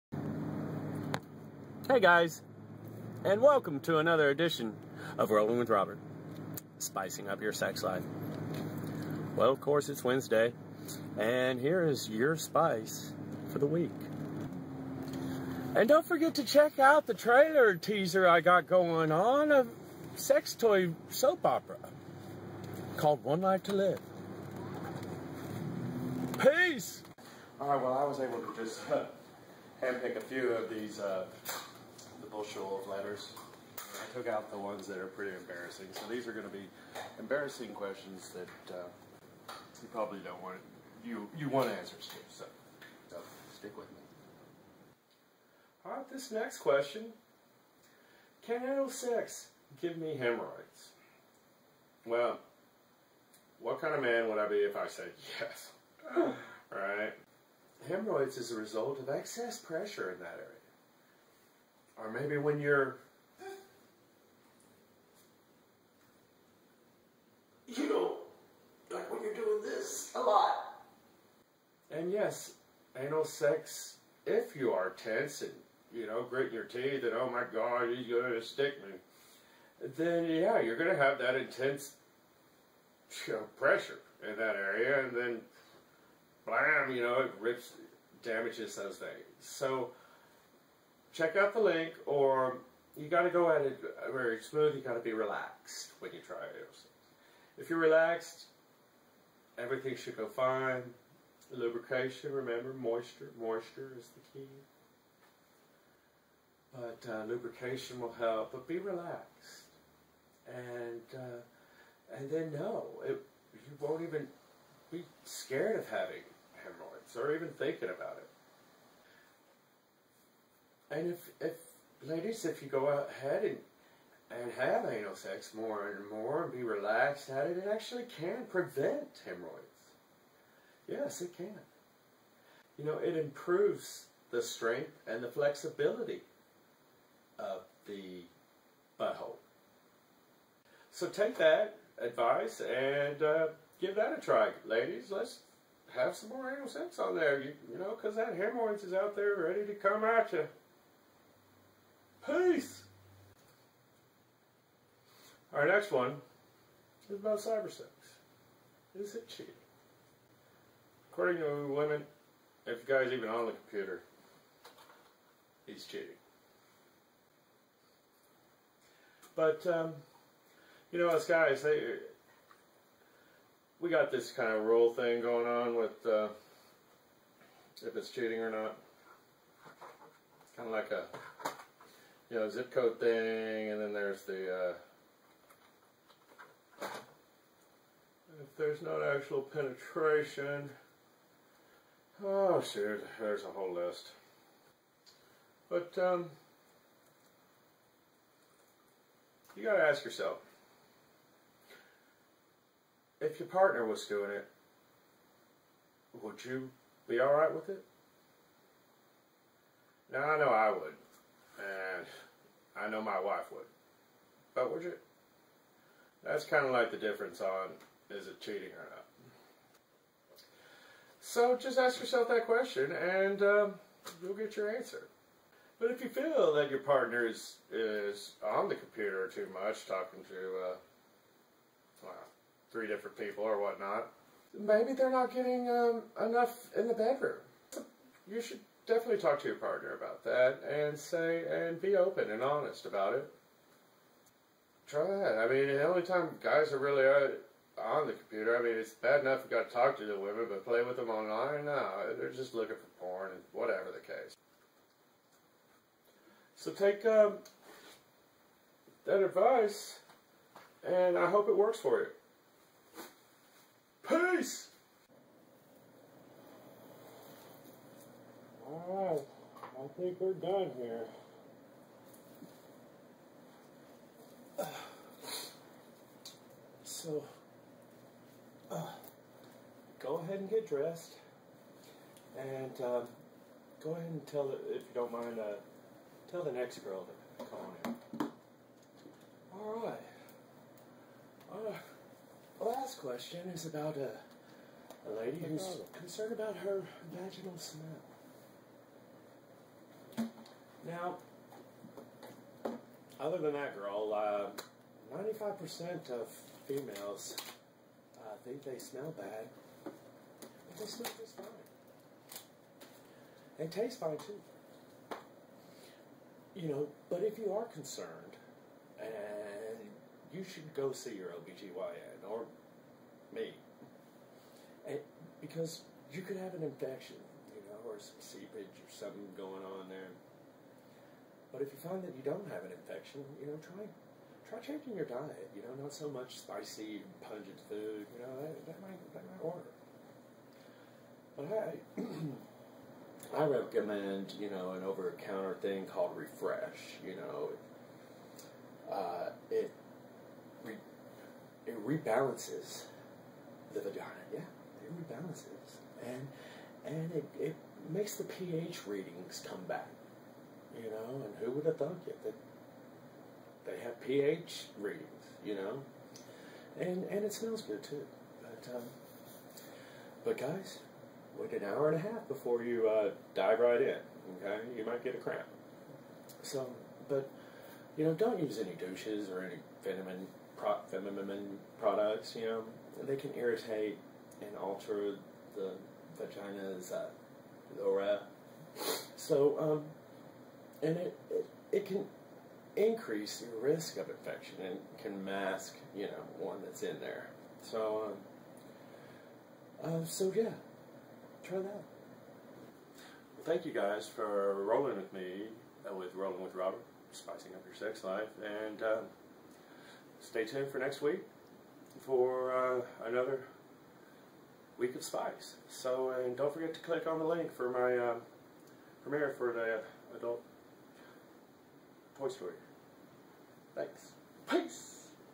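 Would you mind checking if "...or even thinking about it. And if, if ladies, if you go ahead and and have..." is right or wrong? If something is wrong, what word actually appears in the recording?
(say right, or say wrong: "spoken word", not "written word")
right.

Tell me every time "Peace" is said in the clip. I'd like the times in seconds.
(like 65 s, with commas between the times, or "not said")
26 s, 152 s, 264 s, 424 s.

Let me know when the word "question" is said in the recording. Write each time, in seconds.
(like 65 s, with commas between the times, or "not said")
37 s, 46 s, 222 s, 293 s.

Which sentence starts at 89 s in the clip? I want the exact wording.
So, check out the link or you got to go at it very smooth.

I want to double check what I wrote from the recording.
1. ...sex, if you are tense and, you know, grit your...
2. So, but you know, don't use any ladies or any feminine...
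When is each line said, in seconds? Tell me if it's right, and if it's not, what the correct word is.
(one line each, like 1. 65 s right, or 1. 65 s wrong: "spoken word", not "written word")
1. 73 s right
2. 376 s wrong: "douches", not "ladies".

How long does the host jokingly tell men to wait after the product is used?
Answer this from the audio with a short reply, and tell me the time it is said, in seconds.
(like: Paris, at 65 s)
an hour and a half, at 371 s.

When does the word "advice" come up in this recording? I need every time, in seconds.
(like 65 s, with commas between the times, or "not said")
141 s, 259 s.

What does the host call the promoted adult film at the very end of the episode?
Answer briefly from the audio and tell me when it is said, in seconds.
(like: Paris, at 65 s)
the adult Toy Story, at 420 s.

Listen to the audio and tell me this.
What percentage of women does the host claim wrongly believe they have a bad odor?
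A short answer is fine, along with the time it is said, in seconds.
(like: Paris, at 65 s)
95%, at 305 s.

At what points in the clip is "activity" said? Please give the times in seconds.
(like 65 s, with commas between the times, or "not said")
not said.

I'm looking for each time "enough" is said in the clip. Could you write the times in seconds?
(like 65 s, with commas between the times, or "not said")
236 s, 249 s.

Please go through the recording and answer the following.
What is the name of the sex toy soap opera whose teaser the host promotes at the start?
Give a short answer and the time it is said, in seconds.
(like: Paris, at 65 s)
One Life to Live, at 23 s.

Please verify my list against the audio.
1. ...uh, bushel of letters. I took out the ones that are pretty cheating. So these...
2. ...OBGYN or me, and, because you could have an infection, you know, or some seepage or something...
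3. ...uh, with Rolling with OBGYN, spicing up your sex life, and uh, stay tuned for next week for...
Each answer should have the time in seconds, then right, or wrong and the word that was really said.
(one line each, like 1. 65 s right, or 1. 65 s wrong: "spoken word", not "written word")
1. 31 s wrong: "embarrassing", not "cheating"
2. 321 s right
3. 405 s wrong: "Robert", not "OBGYN".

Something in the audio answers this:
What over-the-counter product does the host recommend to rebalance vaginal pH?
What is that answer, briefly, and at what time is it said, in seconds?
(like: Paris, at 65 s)
Refresh, at 346 s.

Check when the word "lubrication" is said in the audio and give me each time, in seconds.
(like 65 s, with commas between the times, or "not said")
101 s, 107 s.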